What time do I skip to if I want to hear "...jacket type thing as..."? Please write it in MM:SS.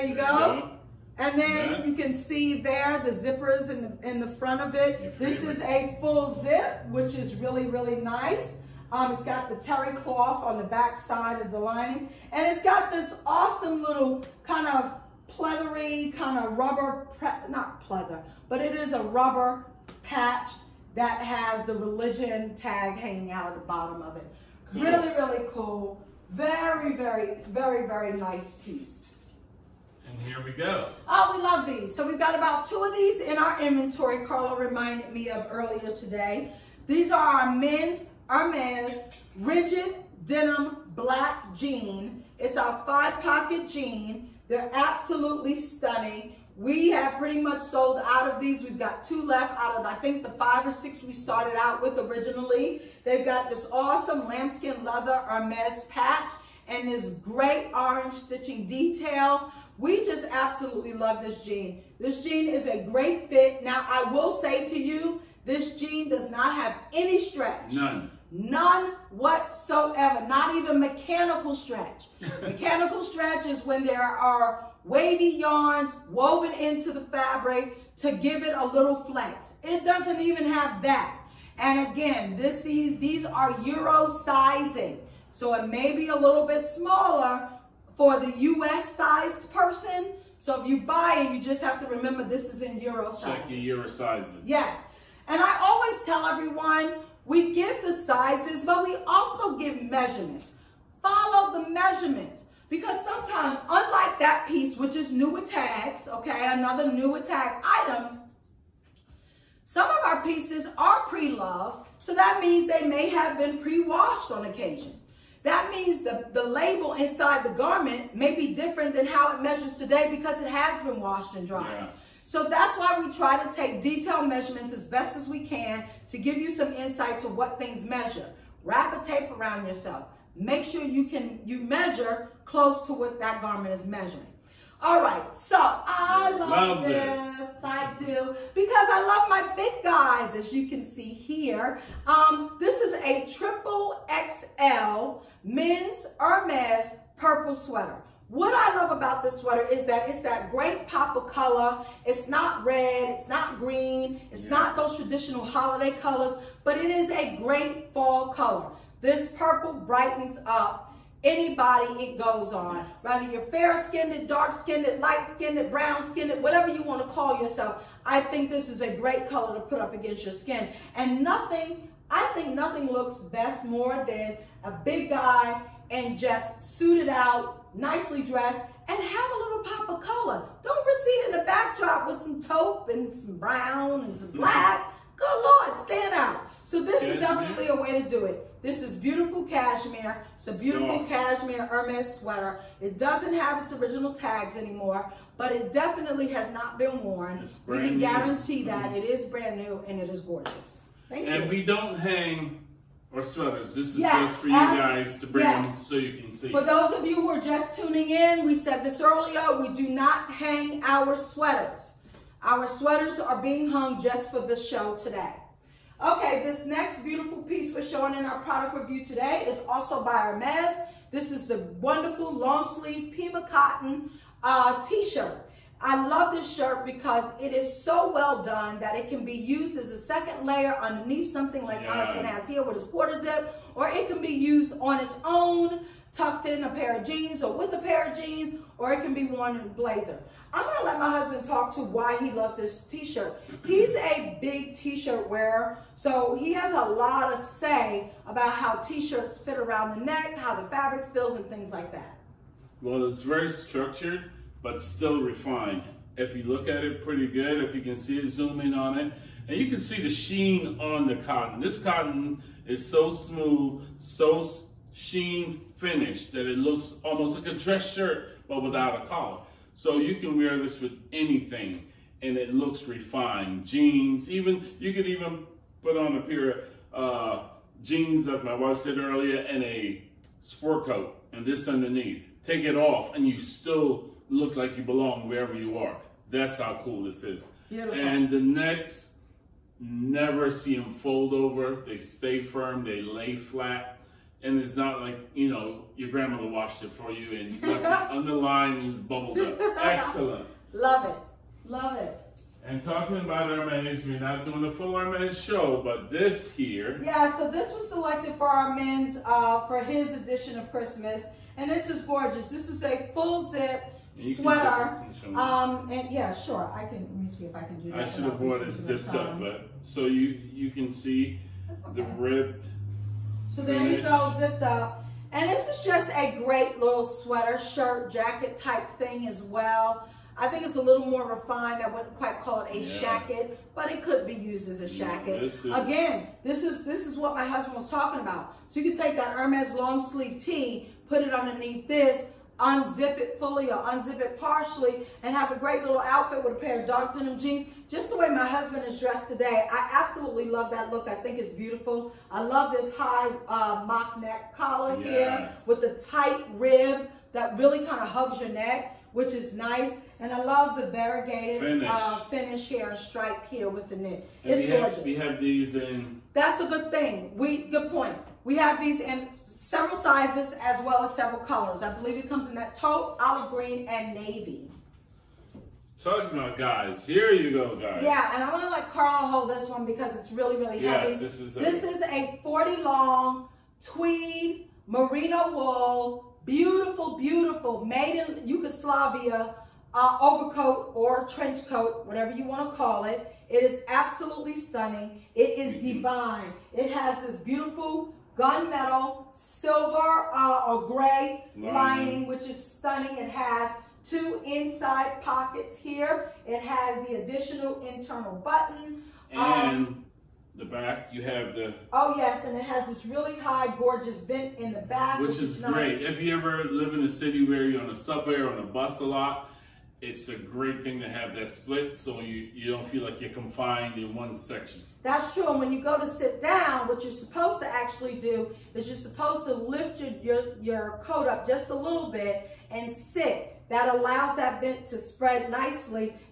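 05:28.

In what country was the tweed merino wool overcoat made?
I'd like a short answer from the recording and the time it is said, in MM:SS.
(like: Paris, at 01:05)
Yugoslavia, at 06:28.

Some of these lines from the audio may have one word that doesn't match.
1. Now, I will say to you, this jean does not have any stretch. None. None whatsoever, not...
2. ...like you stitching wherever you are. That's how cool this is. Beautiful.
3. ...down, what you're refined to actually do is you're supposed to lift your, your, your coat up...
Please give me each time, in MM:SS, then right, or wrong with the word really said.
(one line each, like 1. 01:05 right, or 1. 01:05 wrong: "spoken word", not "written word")
1. 01:03 right
2. 04:44 wrong: "belong", not "stitching"
3. 07:06 wrong: "supposed", not "refined".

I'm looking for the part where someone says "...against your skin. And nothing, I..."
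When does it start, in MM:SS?
02:49.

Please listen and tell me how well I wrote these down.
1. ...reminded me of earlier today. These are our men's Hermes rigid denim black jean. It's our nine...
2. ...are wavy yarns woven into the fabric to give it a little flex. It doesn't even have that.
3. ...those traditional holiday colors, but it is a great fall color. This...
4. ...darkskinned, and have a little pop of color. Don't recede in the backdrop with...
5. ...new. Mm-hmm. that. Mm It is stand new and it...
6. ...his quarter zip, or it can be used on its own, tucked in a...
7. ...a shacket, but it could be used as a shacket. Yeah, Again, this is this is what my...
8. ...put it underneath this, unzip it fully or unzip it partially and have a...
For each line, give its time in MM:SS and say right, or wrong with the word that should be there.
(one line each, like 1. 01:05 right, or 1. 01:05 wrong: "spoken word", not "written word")
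1. 00:34 wrong: "five", not "nine"
2. 01:14 right
3. 02:34 right
4. 02:58 wrong: "dressed", not "darkskinned"
5. 03:18 wrong: "brand", not "stand"
6. 03:52 right
7. 05:32 right
8. 05:41 right.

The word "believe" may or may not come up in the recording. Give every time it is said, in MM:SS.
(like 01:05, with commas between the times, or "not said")
06:11.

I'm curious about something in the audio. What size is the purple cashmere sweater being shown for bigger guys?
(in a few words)
Triple XL.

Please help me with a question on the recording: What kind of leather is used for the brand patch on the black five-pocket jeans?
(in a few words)
Lambskin.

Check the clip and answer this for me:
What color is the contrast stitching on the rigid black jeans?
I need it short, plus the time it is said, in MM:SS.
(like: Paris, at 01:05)
Orange, at 00:57.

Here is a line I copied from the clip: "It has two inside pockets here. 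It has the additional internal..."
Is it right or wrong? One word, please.
right.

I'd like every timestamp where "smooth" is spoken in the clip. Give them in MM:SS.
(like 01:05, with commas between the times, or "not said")
04:23.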